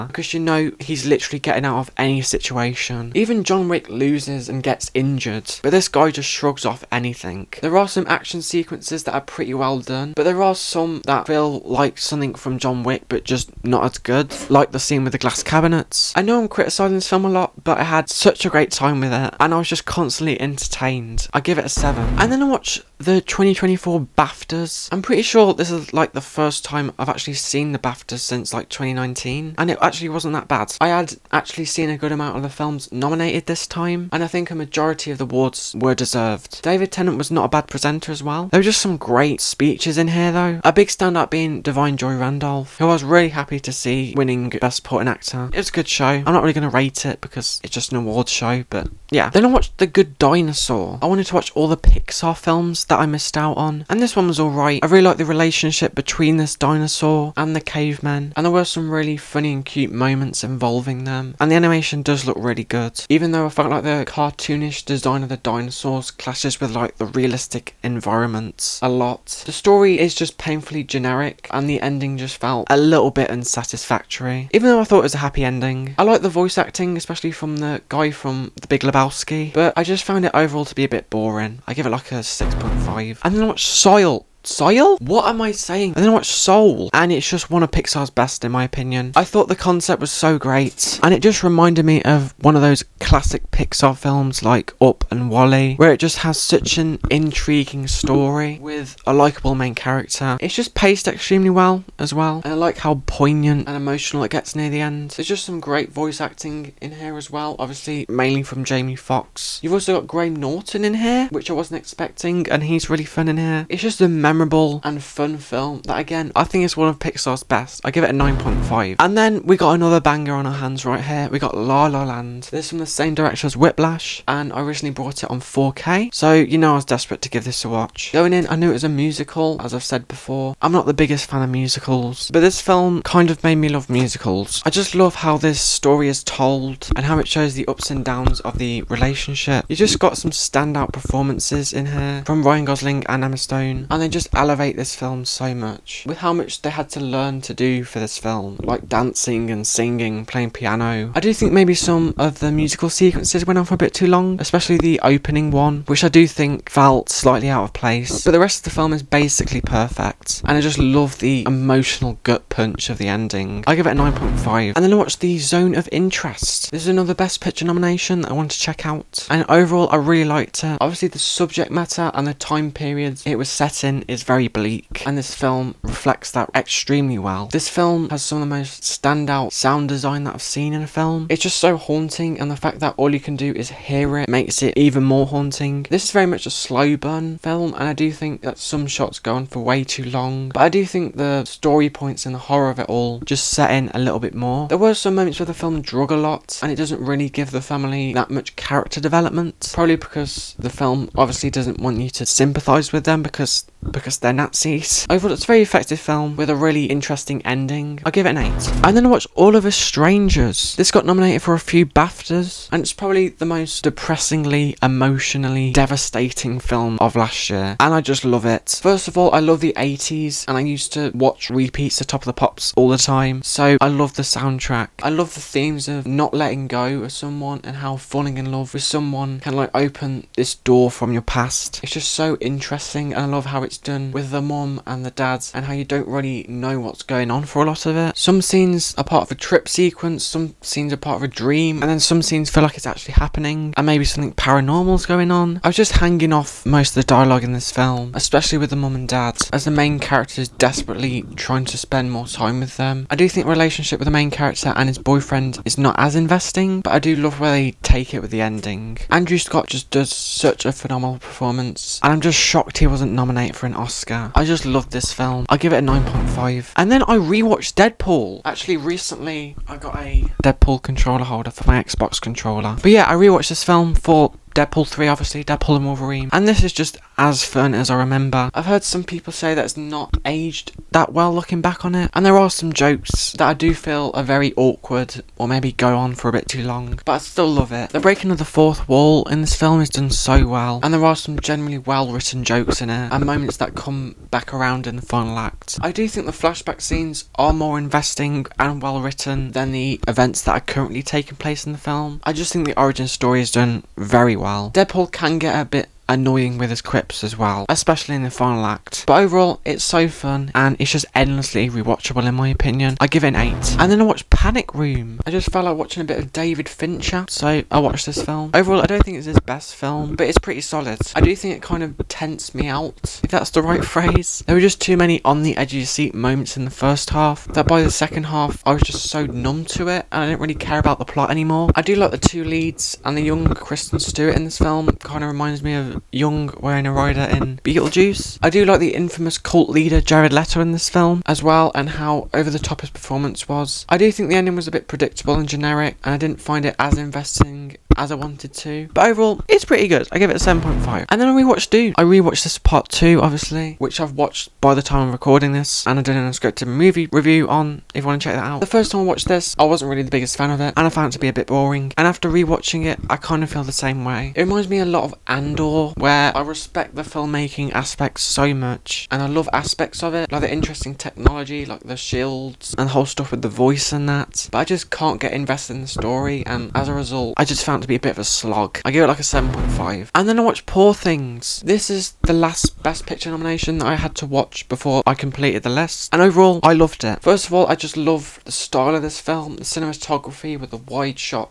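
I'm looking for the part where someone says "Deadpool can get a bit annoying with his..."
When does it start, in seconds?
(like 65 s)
304 s.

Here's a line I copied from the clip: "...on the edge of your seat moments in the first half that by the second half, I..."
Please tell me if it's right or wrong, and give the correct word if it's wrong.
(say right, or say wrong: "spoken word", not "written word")
right.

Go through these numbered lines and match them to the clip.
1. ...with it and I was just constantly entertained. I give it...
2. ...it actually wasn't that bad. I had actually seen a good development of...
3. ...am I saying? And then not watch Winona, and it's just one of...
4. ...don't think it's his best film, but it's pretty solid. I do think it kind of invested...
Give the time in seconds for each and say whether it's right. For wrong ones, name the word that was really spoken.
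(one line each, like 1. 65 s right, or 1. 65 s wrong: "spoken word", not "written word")
1. 18 s right
2. 29 s wrong: "amount", not "development"
3. 85 s wrong: "Soul", not "Winona"
4. 318 s wrong: "tensed", not "invested".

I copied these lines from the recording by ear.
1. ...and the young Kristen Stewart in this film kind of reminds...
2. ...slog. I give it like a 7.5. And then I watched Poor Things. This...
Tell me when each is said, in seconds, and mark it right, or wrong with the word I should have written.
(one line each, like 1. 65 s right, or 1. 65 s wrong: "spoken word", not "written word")
1. 333 s right
2. 378 s right.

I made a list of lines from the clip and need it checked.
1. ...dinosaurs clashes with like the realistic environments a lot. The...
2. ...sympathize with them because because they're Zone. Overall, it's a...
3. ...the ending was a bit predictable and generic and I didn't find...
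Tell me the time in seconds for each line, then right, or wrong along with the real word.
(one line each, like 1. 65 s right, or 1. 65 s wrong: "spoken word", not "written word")
1. 65 s right
2. 202 s wrong: "Nazis", not "Zone"
3. 344 s right.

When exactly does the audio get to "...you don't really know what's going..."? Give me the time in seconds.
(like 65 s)
235 s.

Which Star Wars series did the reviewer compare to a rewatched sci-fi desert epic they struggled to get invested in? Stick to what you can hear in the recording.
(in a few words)
Andor.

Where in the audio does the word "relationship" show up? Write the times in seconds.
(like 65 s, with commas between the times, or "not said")
55 s, 138 s, 253 s.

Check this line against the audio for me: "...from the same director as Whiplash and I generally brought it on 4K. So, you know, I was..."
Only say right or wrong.
wrong.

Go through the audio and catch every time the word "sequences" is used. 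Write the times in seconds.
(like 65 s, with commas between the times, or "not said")
8 s, 152 s, 239 s.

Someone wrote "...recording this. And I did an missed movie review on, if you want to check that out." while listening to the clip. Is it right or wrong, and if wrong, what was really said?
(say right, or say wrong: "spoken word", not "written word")
wrong: "unscripted", not "missed".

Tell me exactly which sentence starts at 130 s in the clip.
I'm not the biggest fan of musicals, but this film kind of made me love musicals.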